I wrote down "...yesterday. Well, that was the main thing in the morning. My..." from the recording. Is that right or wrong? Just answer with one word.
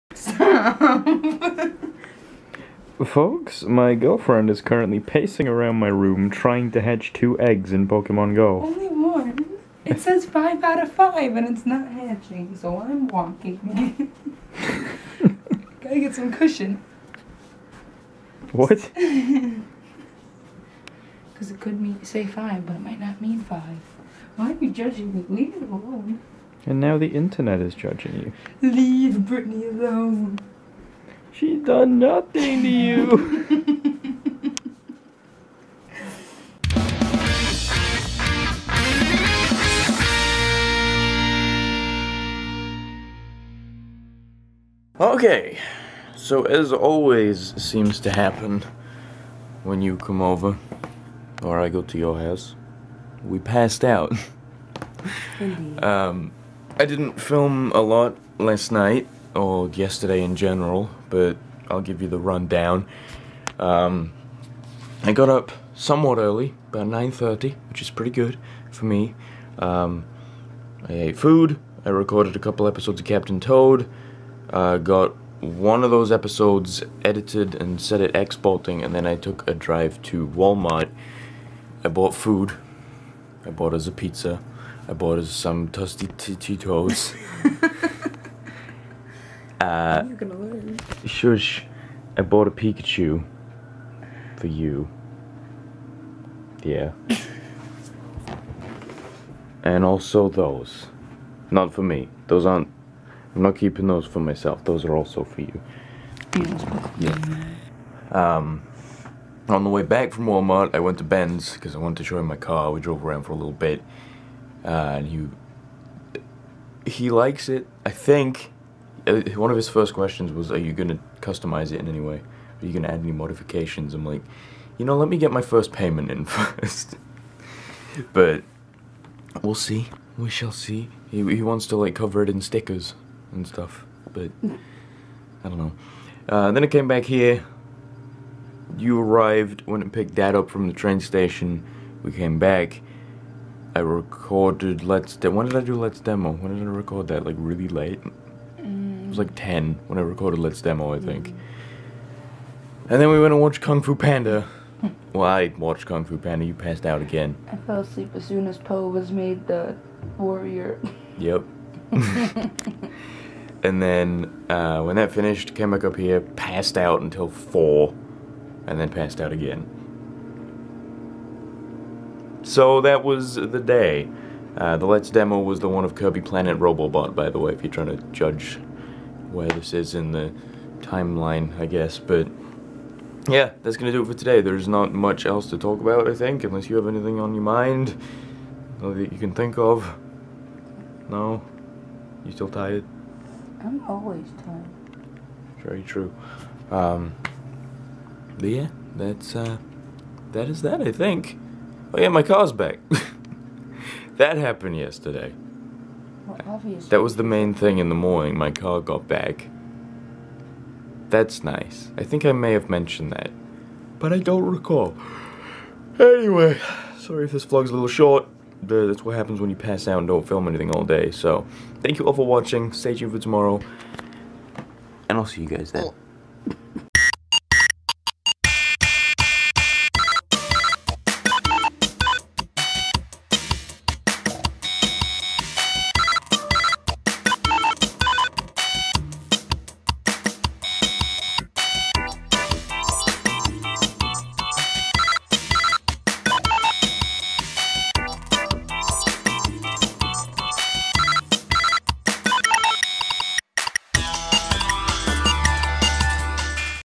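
right.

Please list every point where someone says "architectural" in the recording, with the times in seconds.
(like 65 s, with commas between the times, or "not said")
not said.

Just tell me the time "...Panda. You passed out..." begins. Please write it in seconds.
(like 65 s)
156 s.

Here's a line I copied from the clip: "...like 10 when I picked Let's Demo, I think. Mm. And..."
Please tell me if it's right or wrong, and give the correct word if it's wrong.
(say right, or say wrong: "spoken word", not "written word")
wrong: "recorded", not "picked".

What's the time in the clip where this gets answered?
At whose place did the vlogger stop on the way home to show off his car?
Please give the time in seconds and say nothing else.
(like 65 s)
111 s.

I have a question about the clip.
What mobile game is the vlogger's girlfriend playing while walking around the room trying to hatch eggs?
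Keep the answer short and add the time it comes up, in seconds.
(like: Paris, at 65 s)
Pokemon Go, at 7 s.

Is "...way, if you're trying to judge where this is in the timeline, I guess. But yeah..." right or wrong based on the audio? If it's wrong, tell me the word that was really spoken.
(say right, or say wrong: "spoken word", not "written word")
right.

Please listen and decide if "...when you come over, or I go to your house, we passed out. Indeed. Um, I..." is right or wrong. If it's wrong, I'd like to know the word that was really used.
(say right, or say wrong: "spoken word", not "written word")
right.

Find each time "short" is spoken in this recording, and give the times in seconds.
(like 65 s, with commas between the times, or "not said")
217 s.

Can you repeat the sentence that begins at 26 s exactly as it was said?
And now the internet is judging you.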